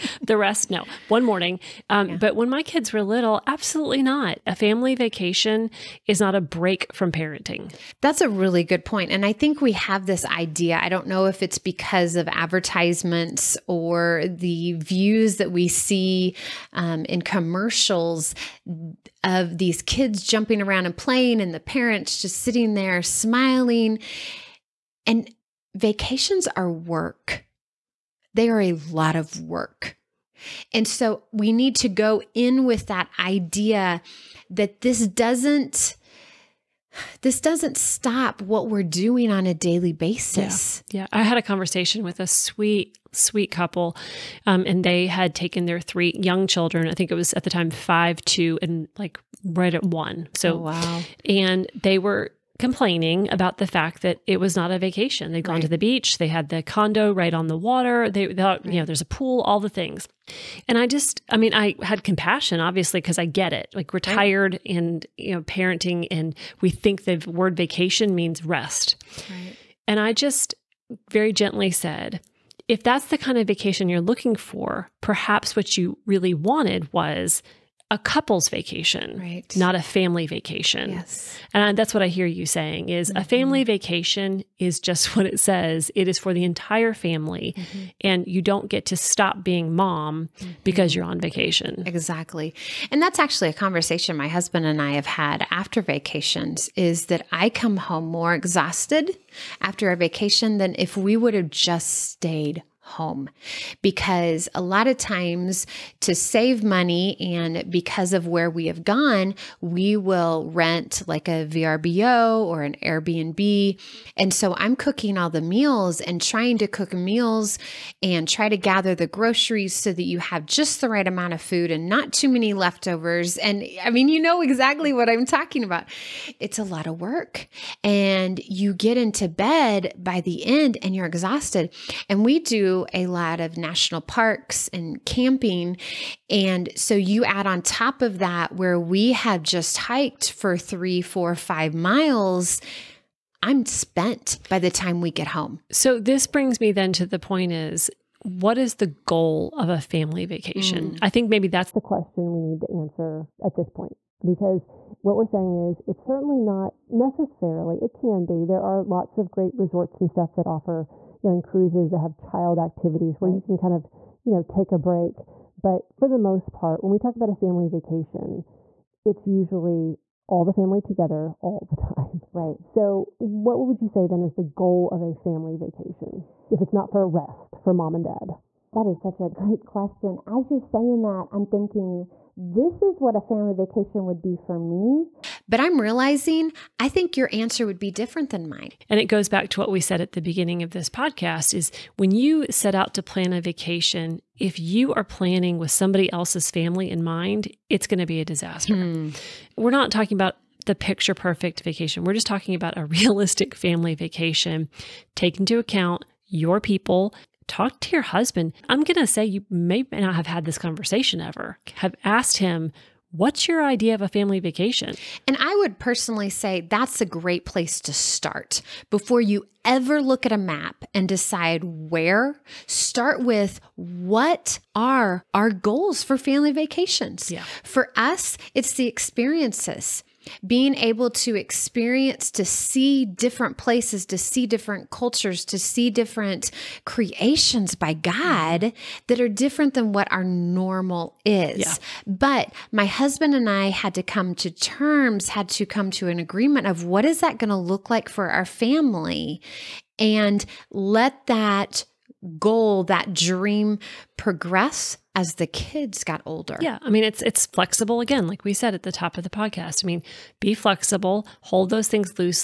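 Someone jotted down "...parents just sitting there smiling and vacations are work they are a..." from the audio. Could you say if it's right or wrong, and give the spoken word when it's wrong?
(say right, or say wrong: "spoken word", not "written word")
right.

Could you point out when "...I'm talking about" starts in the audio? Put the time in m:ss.
2:05.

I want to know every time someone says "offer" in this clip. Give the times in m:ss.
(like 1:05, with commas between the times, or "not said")
2:40.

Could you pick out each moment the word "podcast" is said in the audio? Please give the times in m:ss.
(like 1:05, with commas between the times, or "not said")
3:10, 4:19.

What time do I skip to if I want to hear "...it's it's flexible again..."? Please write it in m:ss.
4:17.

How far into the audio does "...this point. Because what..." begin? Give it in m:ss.
2:33.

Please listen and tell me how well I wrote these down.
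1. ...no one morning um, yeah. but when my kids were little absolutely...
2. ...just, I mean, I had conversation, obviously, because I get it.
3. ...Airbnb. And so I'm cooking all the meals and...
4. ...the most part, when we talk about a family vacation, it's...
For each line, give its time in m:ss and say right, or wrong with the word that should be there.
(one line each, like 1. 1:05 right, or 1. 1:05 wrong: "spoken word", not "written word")
1. 0:00 right
2. 1:00 wrong: "compassion", not "conversation"
3. 1:52 right
4. 2:46 right.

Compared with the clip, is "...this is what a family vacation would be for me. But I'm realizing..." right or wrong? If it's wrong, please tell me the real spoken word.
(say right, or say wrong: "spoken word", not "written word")
right.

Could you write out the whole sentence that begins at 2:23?
I'm spent by the time we get home.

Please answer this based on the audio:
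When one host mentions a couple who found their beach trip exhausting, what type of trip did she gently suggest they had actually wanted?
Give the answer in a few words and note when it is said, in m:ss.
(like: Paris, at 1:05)
A couple's vacation, at 1:17.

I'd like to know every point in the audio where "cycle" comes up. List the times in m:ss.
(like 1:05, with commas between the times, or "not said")
not said.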